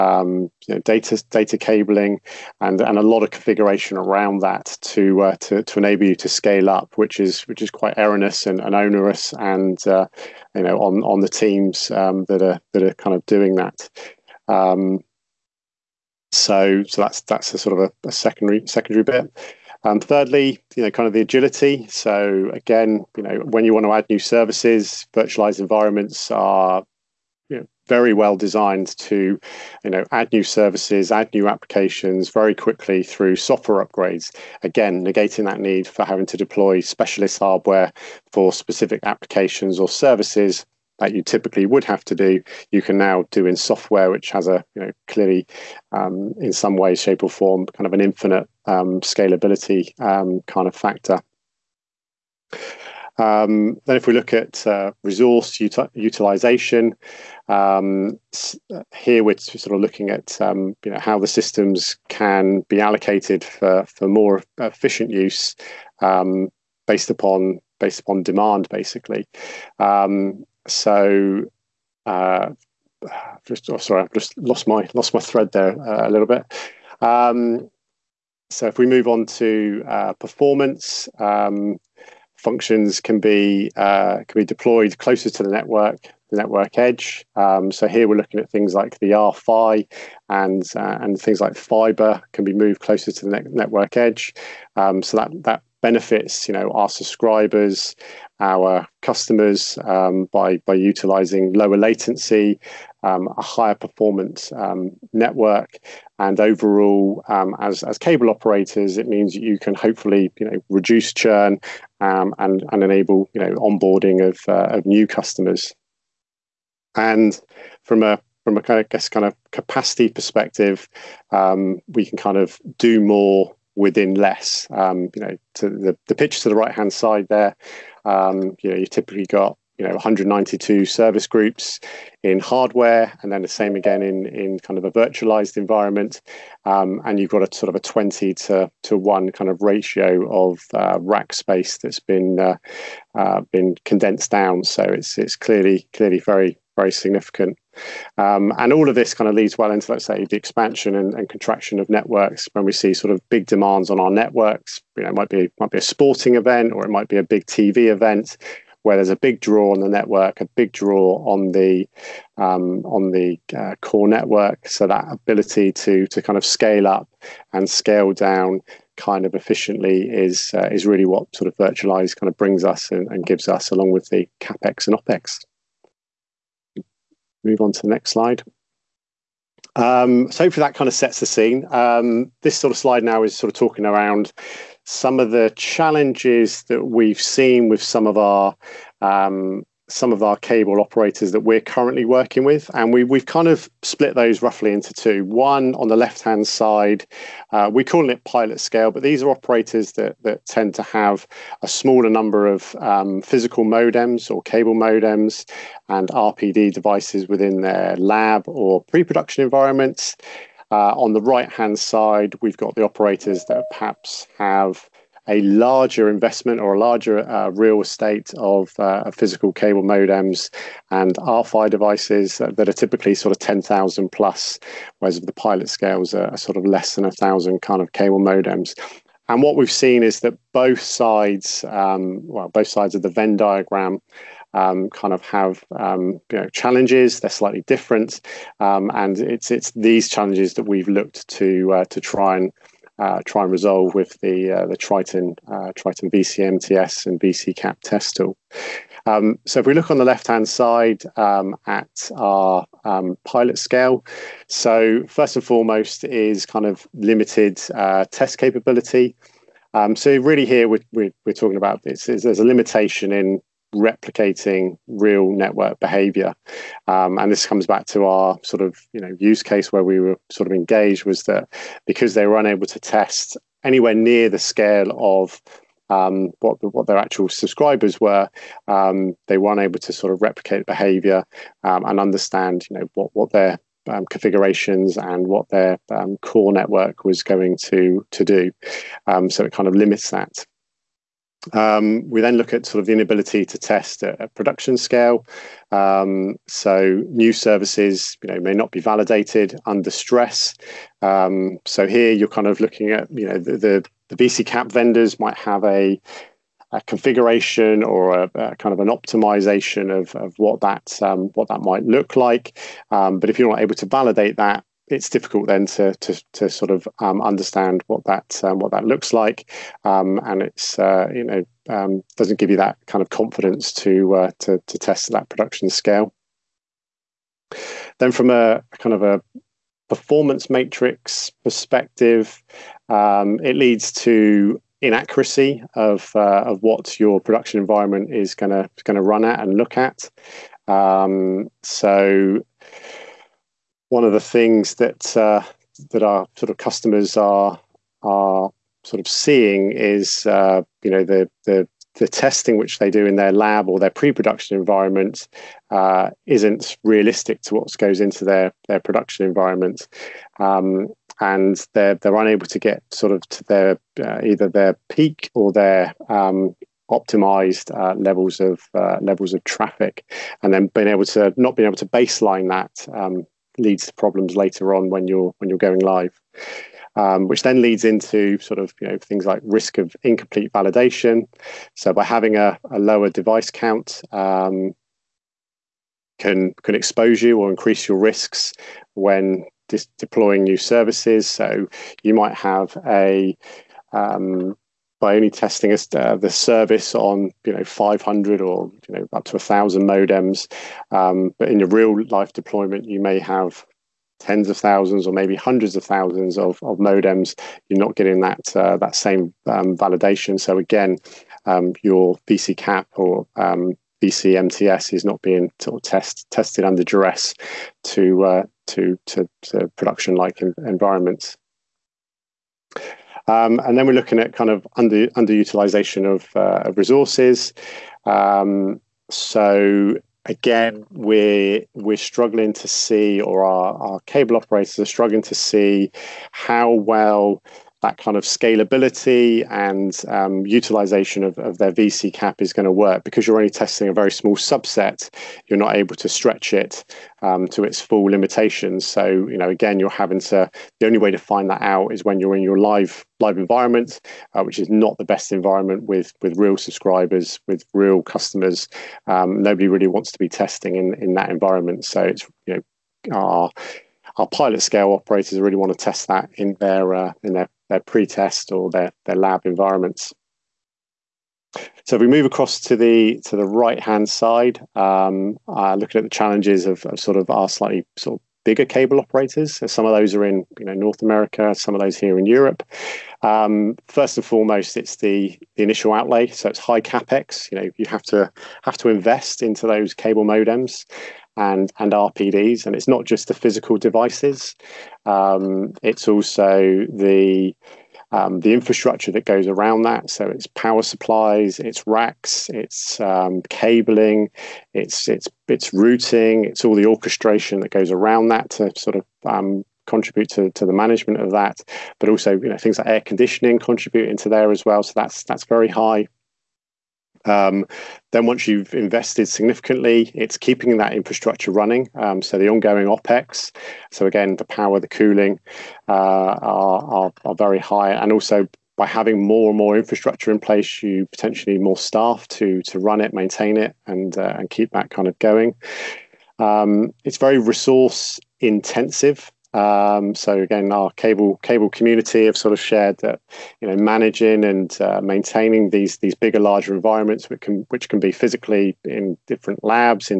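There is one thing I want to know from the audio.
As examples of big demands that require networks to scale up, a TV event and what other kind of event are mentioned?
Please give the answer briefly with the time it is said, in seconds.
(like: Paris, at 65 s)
sporting event, at 155 s.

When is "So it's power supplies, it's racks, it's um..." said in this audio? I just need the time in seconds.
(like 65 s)
500 s.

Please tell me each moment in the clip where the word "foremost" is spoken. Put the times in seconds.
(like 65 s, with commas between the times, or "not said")
255 s, 484 s.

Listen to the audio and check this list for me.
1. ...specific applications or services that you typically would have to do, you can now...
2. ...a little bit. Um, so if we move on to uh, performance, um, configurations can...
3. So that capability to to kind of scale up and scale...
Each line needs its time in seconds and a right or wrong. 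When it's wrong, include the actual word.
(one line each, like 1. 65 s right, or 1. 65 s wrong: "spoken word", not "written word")
1. 38 s right
2. 76 s wrong: "functions", not "configurations"
3. 164 s wrong: "ability", not "capability".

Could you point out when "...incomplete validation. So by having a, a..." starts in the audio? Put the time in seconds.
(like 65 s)
380 s.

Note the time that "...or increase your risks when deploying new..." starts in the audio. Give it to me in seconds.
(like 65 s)
387 s.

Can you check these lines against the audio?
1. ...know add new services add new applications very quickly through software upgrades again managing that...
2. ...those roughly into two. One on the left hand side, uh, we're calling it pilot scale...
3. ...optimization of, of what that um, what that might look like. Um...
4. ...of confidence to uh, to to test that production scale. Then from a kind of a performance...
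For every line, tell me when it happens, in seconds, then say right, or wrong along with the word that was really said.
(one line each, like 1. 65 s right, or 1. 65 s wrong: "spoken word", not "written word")
1. 29 s wrong: "negating", not "managing"
2. 194 s right
3. 308 s right
4. 323 s right.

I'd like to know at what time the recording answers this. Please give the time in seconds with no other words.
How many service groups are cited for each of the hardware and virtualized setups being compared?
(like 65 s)
129 s.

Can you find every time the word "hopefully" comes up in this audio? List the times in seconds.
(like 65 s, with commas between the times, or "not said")
109 s, 180 s.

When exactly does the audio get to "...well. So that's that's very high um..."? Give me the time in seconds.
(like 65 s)
514 s.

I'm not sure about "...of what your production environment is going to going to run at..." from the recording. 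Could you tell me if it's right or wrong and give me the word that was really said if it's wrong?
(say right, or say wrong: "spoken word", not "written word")
right.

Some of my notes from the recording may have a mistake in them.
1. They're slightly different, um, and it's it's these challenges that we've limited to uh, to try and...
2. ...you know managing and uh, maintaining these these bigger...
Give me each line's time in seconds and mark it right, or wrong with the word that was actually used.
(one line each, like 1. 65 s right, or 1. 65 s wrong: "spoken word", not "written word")
1. 237 s wrong: "looked", not "limited"
2. 543 s right.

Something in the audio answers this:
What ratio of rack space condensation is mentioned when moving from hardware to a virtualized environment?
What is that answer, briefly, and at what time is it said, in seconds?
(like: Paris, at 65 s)
20 to 1, at 137 s.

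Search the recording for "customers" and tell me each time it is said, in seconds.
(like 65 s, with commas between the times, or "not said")
99 s, 115 s, 346 s, 458 s.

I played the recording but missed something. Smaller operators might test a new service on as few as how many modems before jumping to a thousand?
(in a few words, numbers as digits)
500.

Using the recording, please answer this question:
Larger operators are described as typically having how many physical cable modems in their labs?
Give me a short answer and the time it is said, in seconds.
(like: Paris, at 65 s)
10,000 plus, at 223 s.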